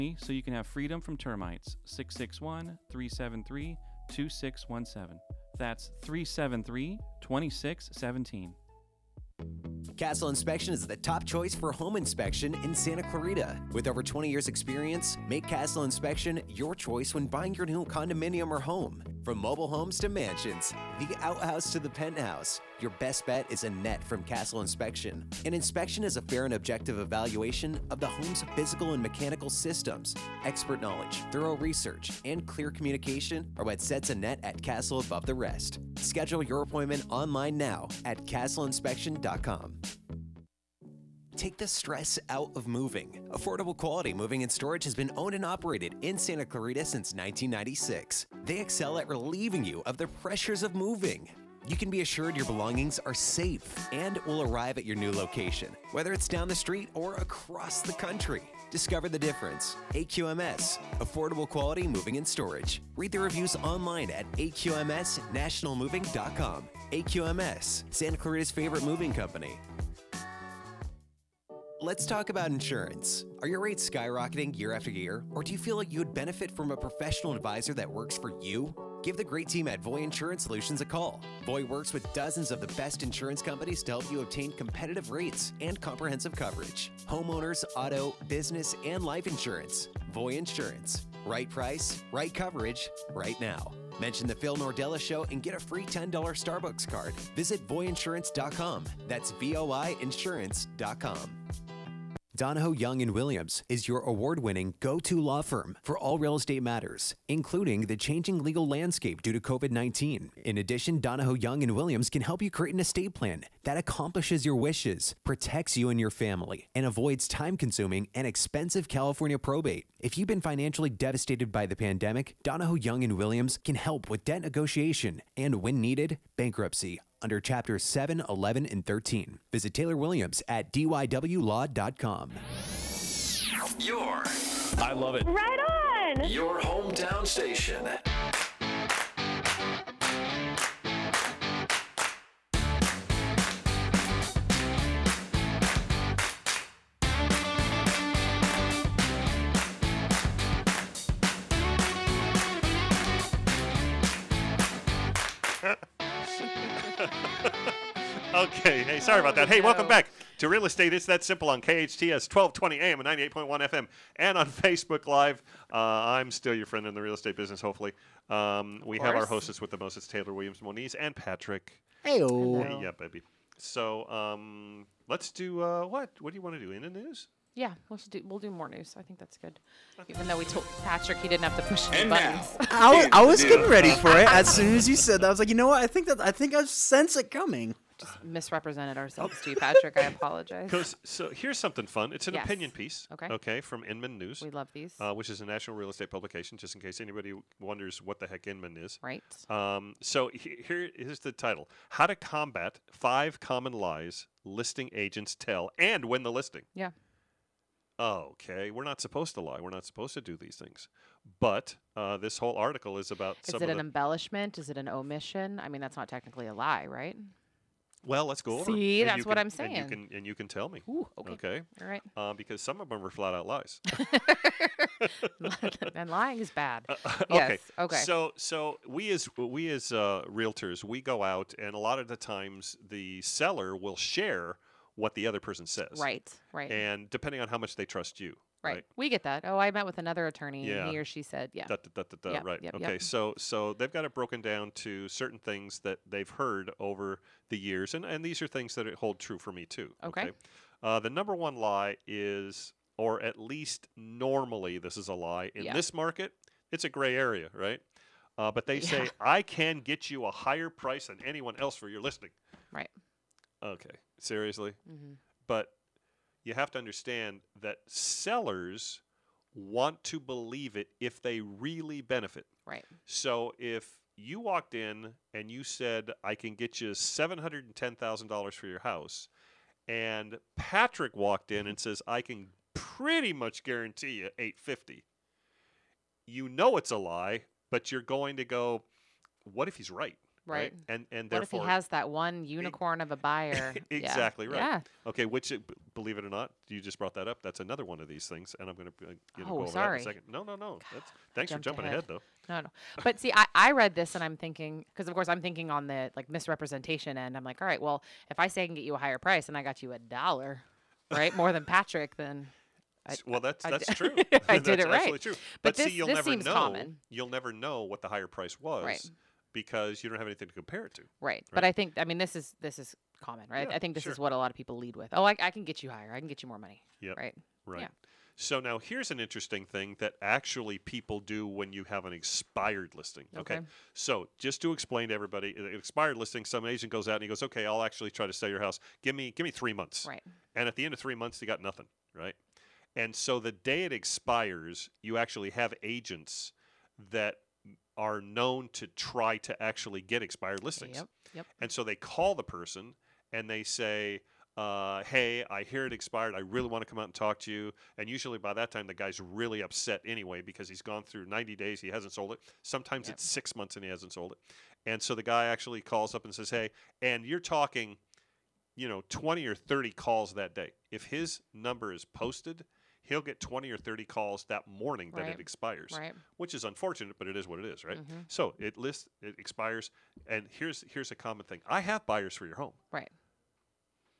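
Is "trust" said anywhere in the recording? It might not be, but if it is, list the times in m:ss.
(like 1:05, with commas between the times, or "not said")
3:57.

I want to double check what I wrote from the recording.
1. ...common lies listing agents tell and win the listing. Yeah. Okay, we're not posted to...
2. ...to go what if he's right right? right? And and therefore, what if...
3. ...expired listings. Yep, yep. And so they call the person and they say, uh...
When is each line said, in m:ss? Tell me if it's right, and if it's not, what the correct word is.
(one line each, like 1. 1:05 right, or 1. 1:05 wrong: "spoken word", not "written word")
1. 3:23 wrong: "supposed", not "posted"
2. 4:48 right
3. 5:50 right.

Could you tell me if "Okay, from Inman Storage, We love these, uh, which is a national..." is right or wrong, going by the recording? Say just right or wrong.
wrong.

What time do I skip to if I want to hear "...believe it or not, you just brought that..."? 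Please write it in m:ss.
4:55.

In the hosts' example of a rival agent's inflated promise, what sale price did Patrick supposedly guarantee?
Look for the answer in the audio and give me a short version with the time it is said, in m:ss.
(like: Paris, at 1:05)
850, at 4:44.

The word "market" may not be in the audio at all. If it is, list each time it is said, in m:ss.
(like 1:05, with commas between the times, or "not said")
4:15.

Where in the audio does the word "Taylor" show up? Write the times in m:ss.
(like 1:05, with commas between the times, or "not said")
2:09, 2:50.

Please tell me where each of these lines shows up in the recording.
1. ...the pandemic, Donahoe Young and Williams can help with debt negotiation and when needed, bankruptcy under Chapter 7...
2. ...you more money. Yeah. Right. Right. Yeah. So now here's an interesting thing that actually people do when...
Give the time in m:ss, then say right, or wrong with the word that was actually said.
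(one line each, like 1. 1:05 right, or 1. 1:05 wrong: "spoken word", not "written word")
1. 2:01 right
2. 5:26 right.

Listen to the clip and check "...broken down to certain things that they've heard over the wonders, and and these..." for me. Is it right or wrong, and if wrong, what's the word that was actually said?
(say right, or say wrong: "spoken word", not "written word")
wrong: "years", not "wonders".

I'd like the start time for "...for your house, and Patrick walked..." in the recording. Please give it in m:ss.
4:38.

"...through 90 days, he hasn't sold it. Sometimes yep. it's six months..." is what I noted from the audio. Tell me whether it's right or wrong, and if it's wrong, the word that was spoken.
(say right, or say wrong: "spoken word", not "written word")
right.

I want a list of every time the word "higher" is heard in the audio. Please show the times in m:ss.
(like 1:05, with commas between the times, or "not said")
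4:20, 5:08, 5:18, 5:25.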